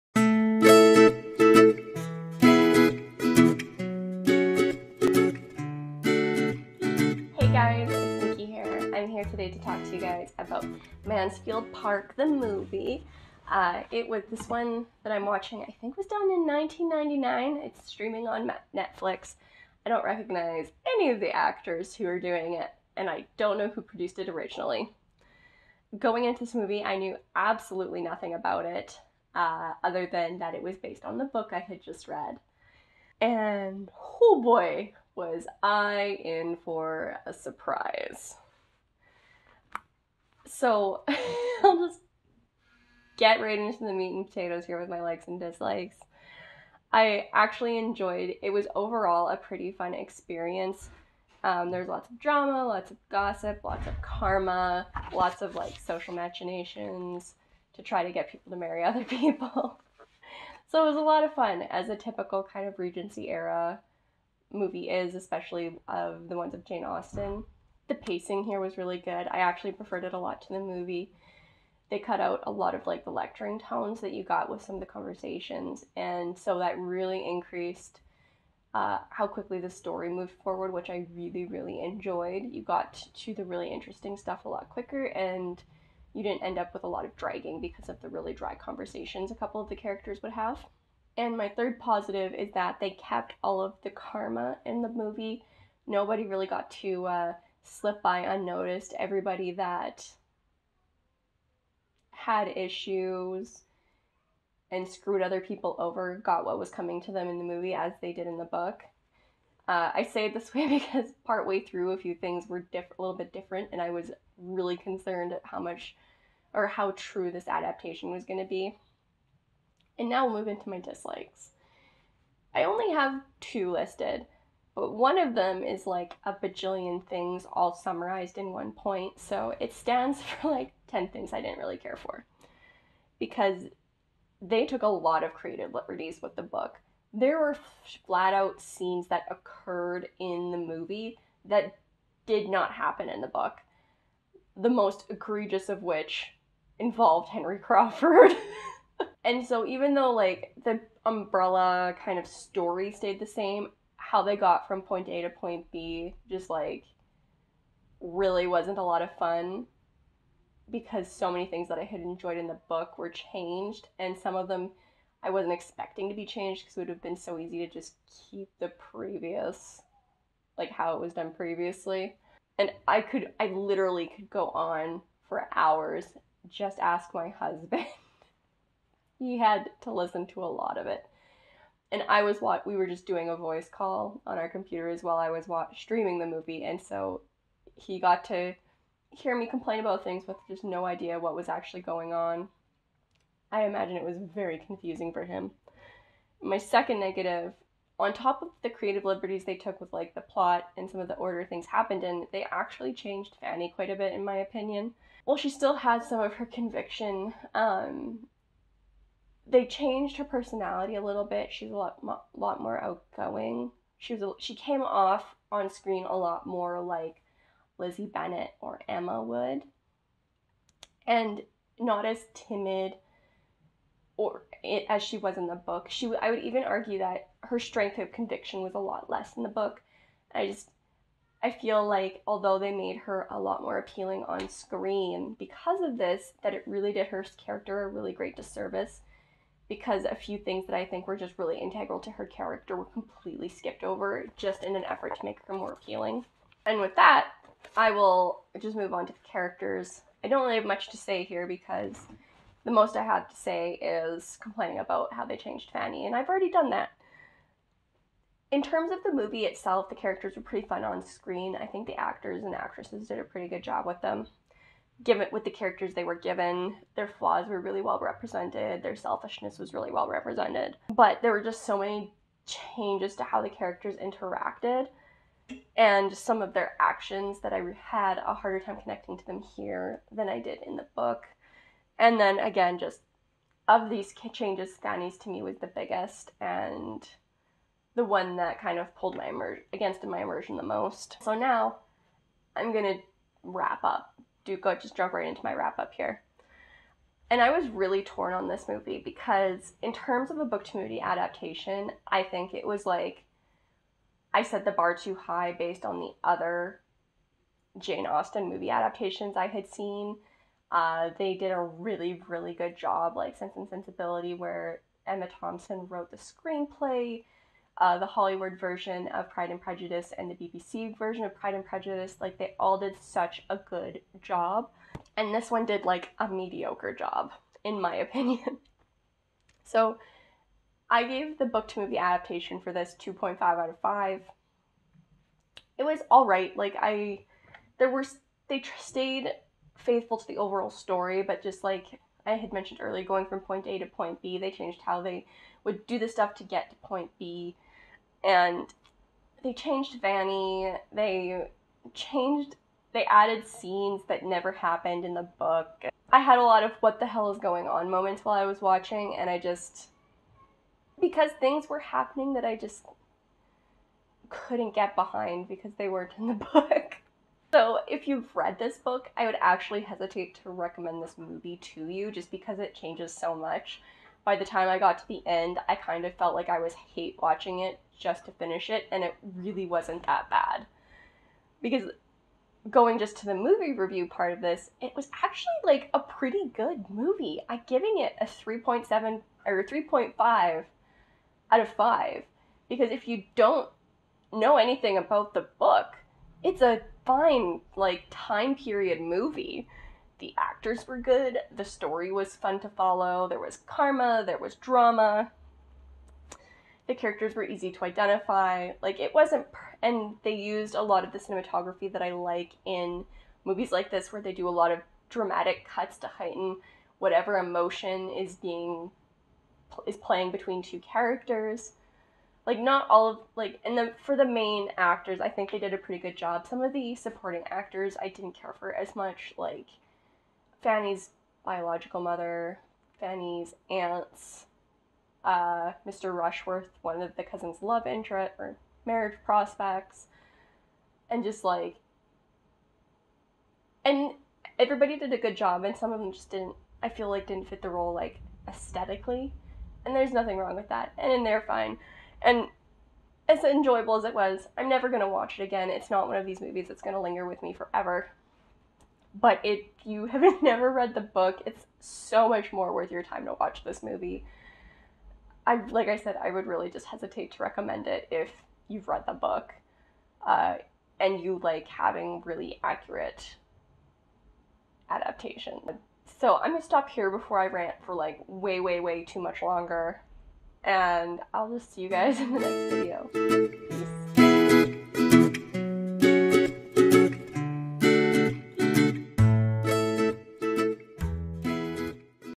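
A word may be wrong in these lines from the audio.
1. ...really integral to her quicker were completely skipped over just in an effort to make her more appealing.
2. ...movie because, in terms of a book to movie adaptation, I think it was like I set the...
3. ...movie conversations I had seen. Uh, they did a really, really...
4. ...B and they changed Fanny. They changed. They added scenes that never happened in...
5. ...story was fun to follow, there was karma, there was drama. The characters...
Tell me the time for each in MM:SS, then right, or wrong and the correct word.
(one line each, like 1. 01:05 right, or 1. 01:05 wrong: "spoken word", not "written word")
1. 04:01 wrong: "character", not "quicker"
2. 04:58 right
3. 05:08 wrong: "adaptations", not "conversations"
4. 05:47 right
5. 06:41 right.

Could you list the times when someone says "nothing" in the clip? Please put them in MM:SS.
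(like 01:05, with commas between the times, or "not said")
00:28, 07:30.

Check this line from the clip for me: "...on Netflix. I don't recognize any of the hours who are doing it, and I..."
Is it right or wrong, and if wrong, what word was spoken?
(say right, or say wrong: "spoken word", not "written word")
wrong: "actors", not "hours".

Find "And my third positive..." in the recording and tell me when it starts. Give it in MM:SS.
01:31.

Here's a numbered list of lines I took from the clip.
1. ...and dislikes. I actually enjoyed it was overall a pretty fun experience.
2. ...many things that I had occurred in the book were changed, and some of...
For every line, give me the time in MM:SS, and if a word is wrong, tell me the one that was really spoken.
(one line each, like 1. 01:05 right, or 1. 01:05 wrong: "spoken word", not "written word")
1. 00:45 right
2. 02:41 wrong: "enjoyed", not "occurred".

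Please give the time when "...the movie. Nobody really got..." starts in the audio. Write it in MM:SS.
01:34.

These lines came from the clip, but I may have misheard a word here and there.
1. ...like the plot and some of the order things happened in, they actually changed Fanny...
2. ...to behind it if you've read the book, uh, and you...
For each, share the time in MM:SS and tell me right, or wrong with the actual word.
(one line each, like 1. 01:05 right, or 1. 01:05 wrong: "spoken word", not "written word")
1. 03:19 right
2. 07:47 wrong: "recommend", not "behind".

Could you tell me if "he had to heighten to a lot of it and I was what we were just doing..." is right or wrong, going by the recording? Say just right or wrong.
wrong.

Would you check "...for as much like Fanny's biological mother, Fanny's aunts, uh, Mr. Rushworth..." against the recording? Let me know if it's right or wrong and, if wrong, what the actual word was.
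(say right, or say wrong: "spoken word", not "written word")
right.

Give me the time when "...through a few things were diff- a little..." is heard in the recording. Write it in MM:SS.
01:51.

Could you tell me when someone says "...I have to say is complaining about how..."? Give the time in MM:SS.
04:12.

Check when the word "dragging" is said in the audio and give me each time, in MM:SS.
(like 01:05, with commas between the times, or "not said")
01:27.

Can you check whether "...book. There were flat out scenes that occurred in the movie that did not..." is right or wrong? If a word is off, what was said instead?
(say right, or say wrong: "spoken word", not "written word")
right.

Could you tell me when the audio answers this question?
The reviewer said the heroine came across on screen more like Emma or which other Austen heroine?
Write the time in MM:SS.
03:37.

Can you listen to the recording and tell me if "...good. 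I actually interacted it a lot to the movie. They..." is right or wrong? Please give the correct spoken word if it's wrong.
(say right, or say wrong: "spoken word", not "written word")
wrong: "preferred", not "interacted".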